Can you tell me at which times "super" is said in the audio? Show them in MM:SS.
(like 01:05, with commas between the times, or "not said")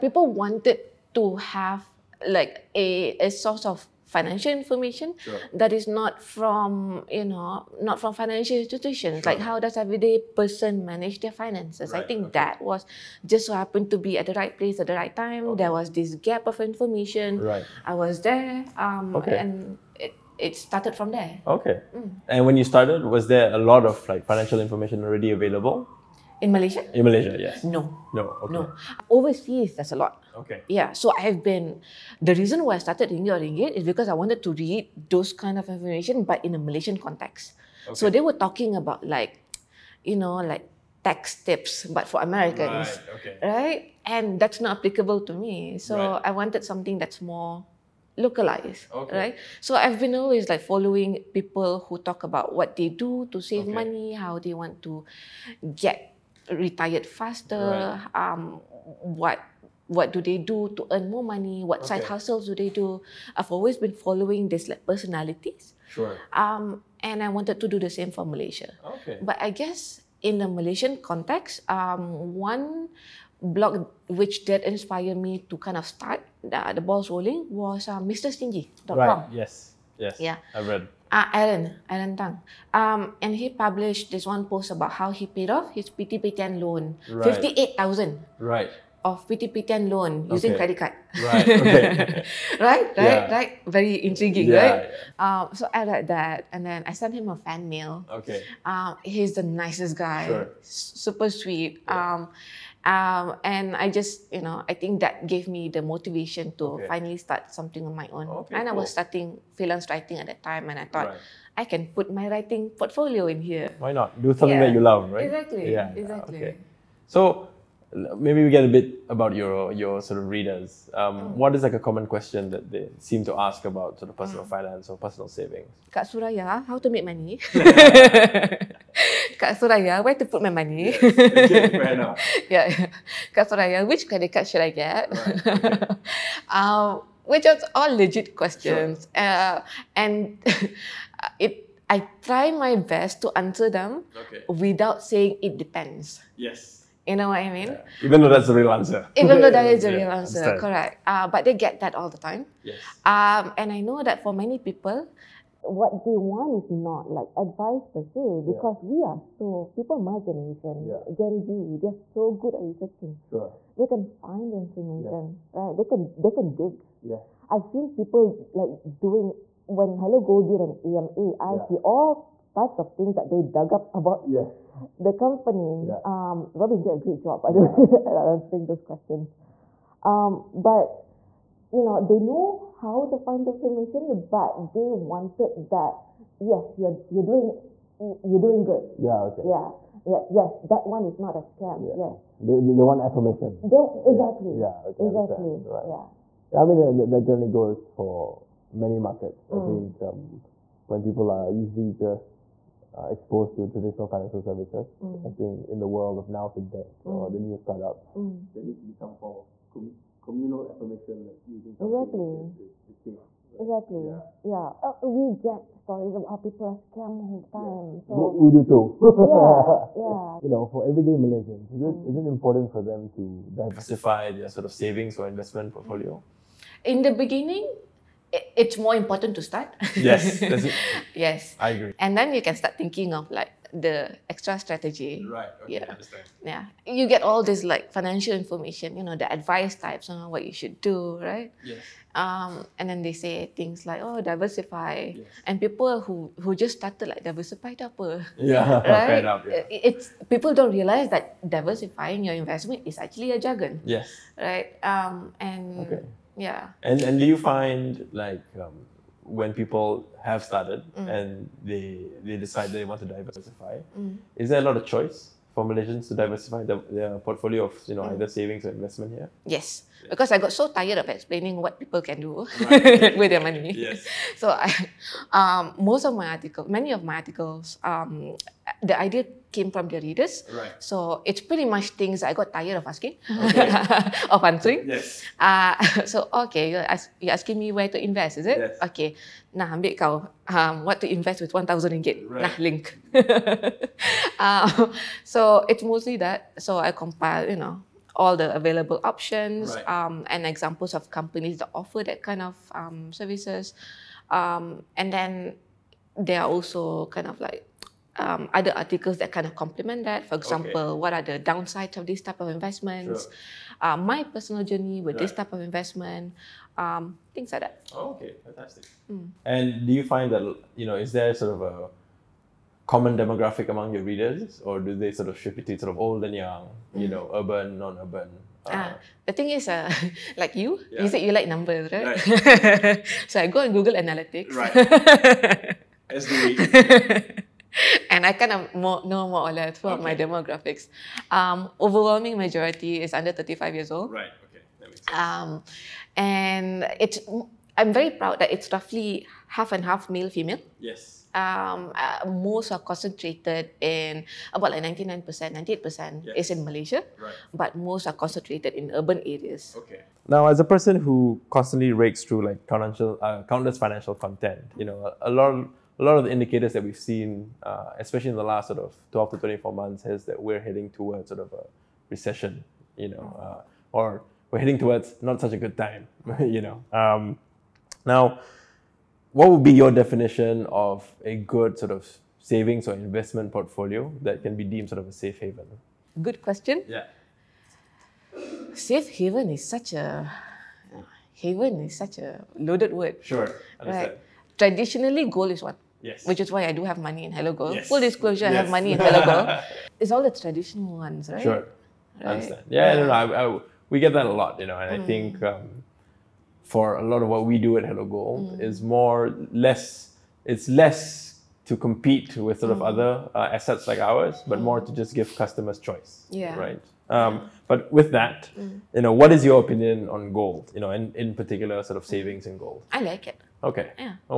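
01:40.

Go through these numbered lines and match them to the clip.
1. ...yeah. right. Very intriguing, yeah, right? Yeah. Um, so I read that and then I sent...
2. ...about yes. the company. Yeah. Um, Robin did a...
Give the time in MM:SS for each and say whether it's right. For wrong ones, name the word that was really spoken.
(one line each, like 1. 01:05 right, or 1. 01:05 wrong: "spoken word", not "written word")
1. 01:32 right
2. 02:53 right.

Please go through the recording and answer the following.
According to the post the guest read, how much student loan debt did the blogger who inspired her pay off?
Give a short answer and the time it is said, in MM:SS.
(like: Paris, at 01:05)
58,000, at 01:27.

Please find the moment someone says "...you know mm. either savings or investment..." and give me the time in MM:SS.
04:27.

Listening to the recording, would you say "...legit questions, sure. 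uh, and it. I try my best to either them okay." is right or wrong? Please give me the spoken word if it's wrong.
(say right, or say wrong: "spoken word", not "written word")
wrong: "answer", not "either".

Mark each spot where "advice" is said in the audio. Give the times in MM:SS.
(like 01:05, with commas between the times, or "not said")
02:37, 03:59.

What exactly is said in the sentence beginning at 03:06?
Yes, you're you're doing you're doing good.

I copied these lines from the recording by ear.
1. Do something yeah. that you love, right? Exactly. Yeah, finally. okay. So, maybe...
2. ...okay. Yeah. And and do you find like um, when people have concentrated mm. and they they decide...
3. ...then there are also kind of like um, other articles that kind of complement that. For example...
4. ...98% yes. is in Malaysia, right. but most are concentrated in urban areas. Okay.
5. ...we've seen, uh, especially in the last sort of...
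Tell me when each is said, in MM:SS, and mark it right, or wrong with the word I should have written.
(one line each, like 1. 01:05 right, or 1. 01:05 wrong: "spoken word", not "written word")
1. 01:54 wrong: "exactly", not "finally"
2. 04:15 wrong: "started", not "concentrated"
3. 05:05 right
4. 05:55 right
5. 06:06 right.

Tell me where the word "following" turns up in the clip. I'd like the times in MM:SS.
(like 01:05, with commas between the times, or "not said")
00:50, 01:03.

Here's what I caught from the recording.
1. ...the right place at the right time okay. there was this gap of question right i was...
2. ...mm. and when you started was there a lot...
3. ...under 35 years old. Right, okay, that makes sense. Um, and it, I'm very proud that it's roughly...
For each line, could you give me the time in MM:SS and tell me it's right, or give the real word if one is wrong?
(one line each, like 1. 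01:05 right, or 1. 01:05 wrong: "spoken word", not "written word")
1. 00:14 wrong: "information", not "question"
2. 00:21 right
3. 05:43 right.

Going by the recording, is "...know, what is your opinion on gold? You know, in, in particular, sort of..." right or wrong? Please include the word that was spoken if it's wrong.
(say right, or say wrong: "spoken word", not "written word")
right.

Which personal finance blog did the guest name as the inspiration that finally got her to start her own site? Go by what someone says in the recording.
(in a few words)
Mr Stingy.com.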